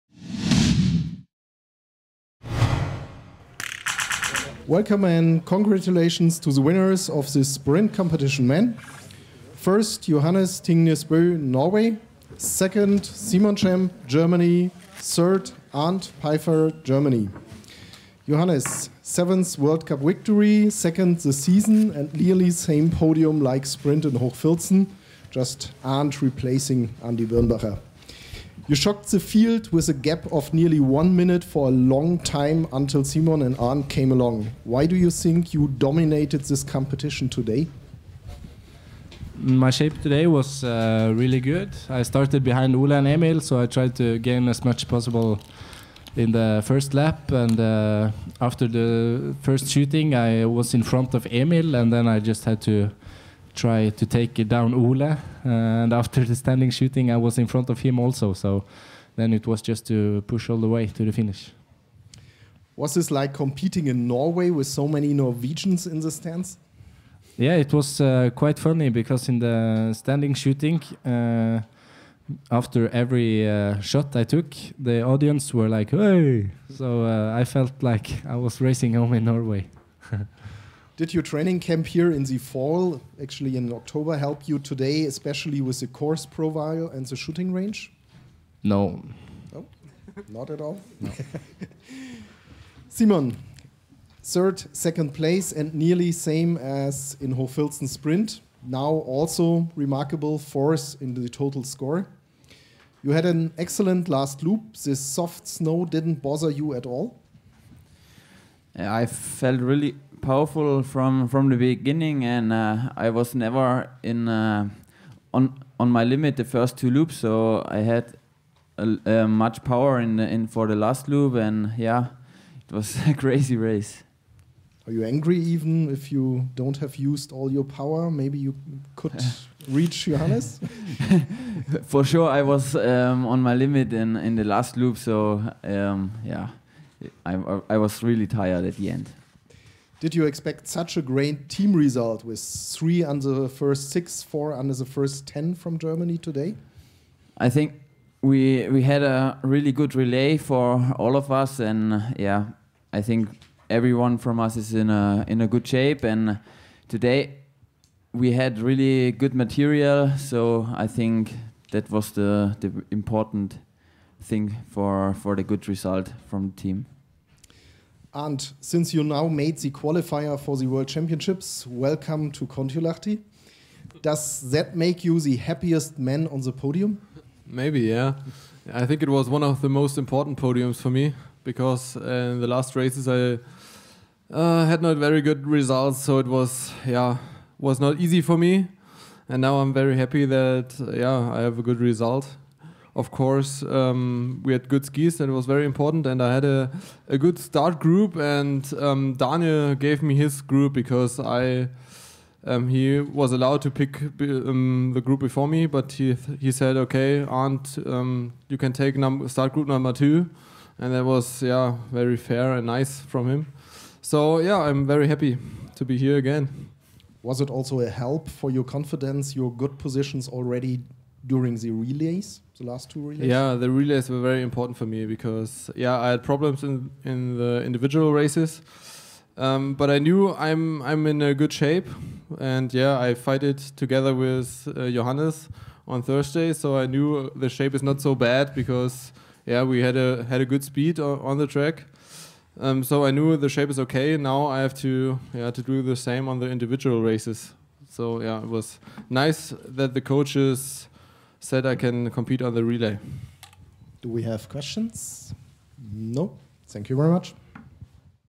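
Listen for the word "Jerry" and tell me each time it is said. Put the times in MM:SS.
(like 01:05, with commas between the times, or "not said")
not said.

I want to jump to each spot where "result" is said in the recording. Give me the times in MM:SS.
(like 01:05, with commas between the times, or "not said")
02:21, 02:45, 03:05, 03:11.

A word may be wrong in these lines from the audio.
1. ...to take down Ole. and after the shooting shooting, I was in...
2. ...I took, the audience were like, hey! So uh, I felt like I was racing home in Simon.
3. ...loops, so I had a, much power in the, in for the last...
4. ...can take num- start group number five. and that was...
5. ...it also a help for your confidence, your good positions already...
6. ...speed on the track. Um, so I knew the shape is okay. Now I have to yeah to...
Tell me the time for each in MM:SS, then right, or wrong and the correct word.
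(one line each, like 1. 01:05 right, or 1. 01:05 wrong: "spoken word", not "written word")
1. 00:53 wrong: "standing", not "shooting"
2. 01:14 wrong: "Norway", not "Simon"
3. 01:56 right
4. 03:28 wrong: "two", not "five"
5. 03:37 right
6. 04:00 right.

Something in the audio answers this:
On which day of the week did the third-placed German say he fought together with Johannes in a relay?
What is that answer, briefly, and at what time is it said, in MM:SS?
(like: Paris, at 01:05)
Thursday, at 03:56.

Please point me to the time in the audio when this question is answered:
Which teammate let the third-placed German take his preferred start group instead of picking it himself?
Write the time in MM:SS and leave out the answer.
03:19.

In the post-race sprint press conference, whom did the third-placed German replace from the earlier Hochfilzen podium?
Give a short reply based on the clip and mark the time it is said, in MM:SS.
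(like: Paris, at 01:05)
Andy Birnbacher, at 00:27.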